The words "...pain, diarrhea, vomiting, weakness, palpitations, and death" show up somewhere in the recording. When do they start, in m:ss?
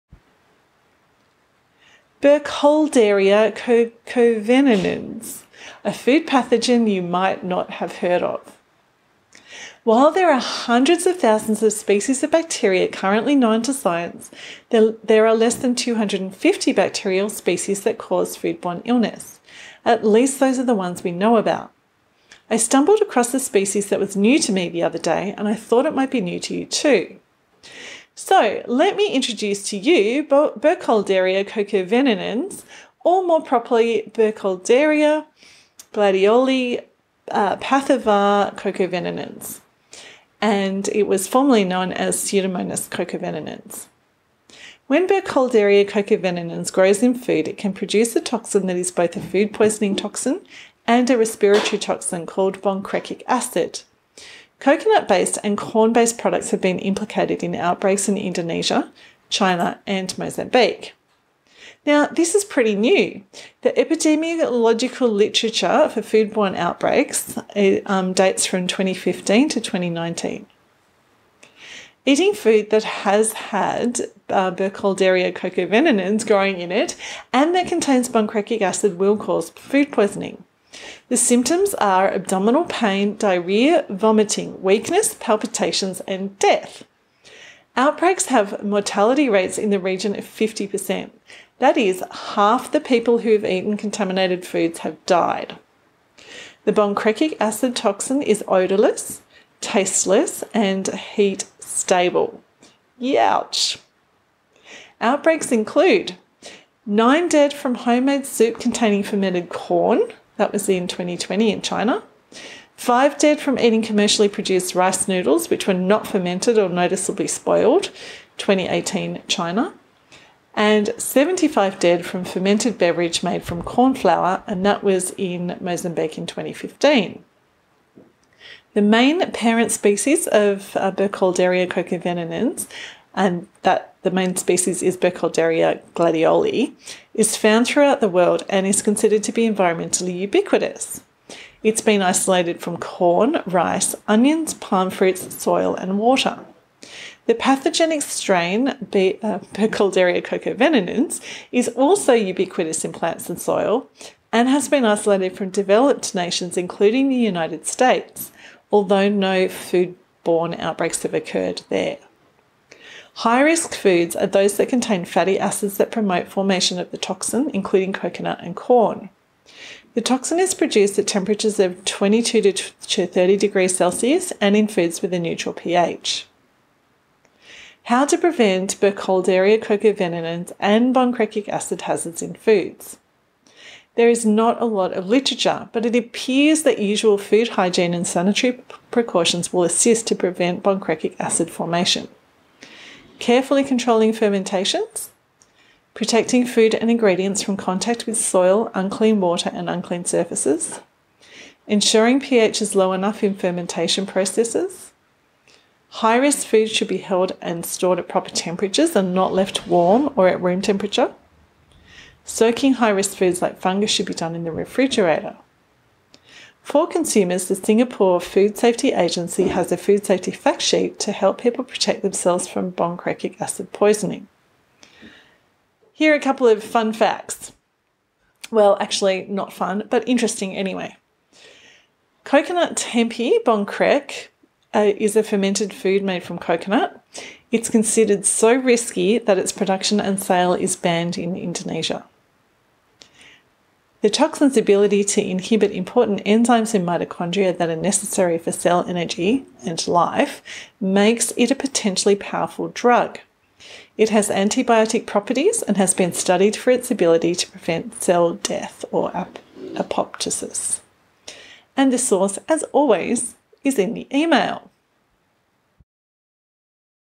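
1:22.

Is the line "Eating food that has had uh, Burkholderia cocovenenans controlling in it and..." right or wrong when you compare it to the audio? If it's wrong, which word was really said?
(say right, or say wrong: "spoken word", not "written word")
wrong: "growing", not "controlling".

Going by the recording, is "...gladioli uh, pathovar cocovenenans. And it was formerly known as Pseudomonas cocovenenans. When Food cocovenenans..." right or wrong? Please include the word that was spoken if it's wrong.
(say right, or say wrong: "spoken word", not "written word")
wrong: "Burkholderia", not "Food".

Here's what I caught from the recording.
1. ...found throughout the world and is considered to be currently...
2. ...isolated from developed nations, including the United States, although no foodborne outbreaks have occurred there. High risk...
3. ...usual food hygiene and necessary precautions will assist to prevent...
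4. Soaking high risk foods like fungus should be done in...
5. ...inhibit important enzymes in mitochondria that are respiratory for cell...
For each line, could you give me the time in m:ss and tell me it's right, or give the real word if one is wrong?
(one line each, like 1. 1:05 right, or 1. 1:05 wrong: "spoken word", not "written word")
1. 2:17 wrong: "environmentally", not "currently"
2. 2:34 right
3. 3:06 wrong: "sanitary", not "necessary"
4. 3:32 right
5. 4:05 wrong: "necessary", not "respiratory".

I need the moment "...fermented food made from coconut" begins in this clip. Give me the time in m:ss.
3:55.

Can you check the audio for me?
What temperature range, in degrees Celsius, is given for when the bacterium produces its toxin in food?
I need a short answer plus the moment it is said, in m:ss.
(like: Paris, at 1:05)
22 to 30, at 2:51.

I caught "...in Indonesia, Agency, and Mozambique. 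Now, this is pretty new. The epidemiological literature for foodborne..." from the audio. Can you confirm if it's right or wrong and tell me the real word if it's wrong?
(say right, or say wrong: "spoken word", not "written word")
wrong: "China", not "Agency".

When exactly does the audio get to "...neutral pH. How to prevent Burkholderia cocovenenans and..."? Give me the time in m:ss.
2:55.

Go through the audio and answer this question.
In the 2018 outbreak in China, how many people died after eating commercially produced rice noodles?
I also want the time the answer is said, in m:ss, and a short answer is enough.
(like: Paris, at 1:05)
5, at 1:52.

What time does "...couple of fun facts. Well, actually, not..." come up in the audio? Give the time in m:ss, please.
3:46.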